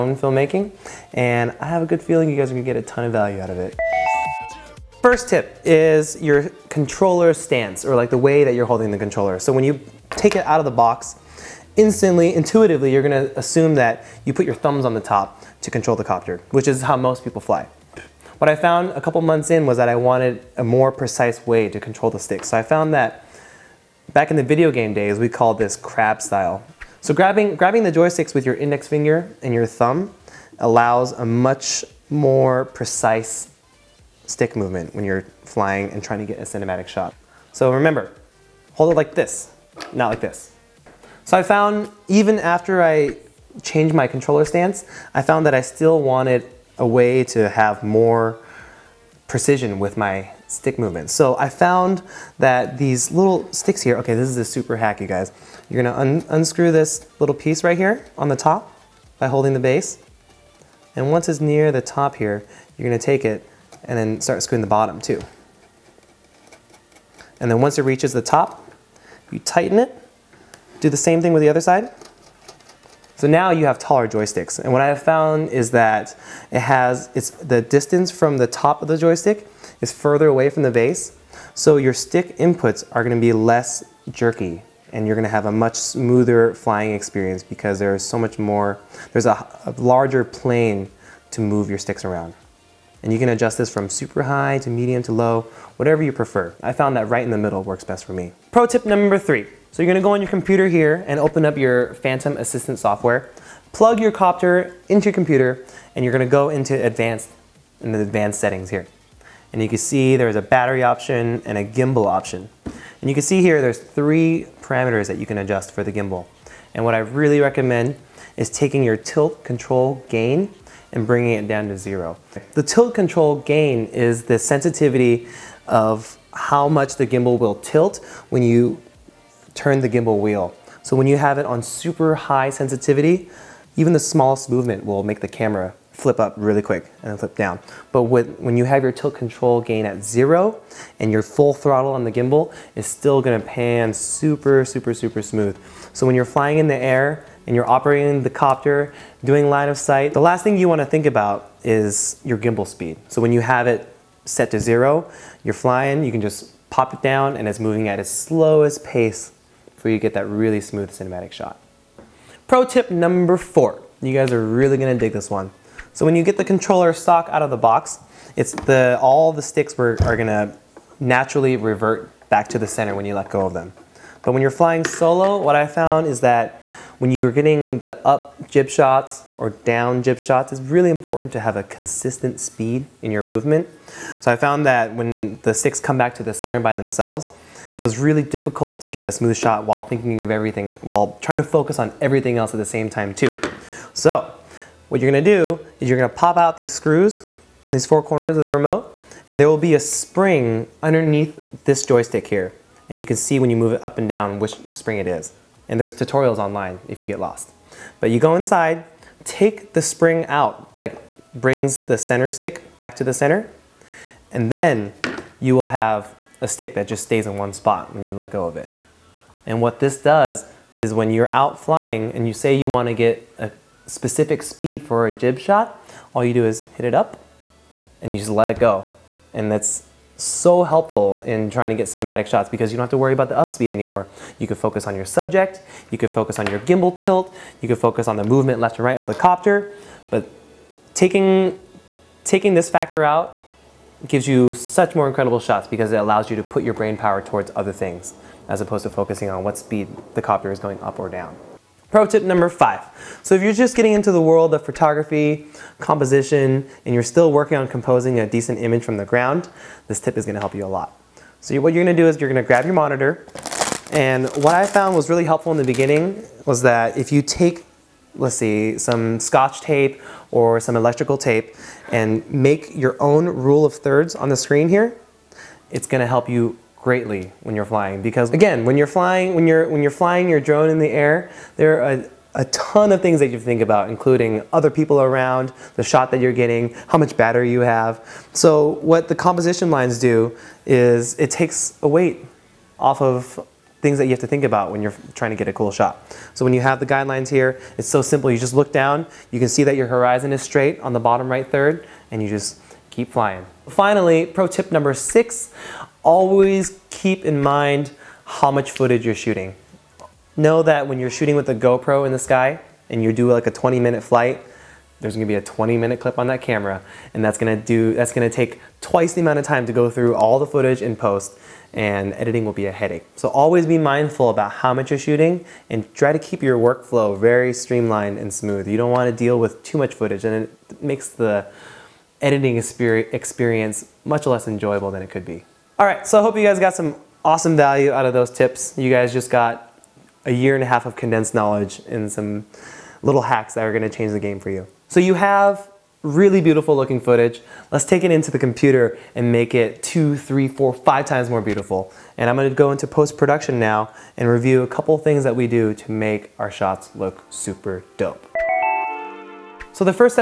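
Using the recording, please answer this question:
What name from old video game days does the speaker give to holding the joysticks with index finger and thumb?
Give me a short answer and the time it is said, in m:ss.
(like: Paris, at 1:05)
crab style, at 0:25.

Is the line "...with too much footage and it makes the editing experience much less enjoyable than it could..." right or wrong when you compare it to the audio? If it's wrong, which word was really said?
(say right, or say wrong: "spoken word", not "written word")
right.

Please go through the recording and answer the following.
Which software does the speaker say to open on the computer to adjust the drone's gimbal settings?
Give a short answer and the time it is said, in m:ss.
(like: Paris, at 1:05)
Phantom Assistant, at 1:41.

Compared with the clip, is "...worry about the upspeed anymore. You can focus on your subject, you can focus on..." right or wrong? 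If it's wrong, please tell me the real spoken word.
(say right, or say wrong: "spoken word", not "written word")
right.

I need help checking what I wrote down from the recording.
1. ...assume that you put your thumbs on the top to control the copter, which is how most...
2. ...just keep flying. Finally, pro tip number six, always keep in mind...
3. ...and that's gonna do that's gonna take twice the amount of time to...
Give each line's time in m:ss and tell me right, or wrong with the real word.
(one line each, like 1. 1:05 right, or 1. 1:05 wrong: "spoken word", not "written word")
1. 0:13 right
2. 5:02 right
3. 5:17 right.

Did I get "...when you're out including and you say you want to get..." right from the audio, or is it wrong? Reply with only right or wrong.
wrong.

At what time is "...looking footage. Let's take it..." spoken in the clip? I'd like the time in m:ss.
5:46.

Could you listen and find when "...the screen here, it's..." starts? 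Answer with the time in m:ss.
4:34.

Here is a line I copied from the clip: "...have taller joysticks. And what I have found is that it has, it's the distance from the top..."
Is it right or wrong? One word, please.
right.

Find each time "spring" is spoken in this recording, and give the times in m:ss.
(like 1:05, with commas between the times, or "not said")
3:19, 3:24, 3:29.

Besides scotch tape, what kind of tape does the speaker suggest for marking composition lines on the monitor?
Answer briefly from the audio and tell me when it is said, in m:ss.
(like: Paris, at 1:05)
electrical tape, at 4:30.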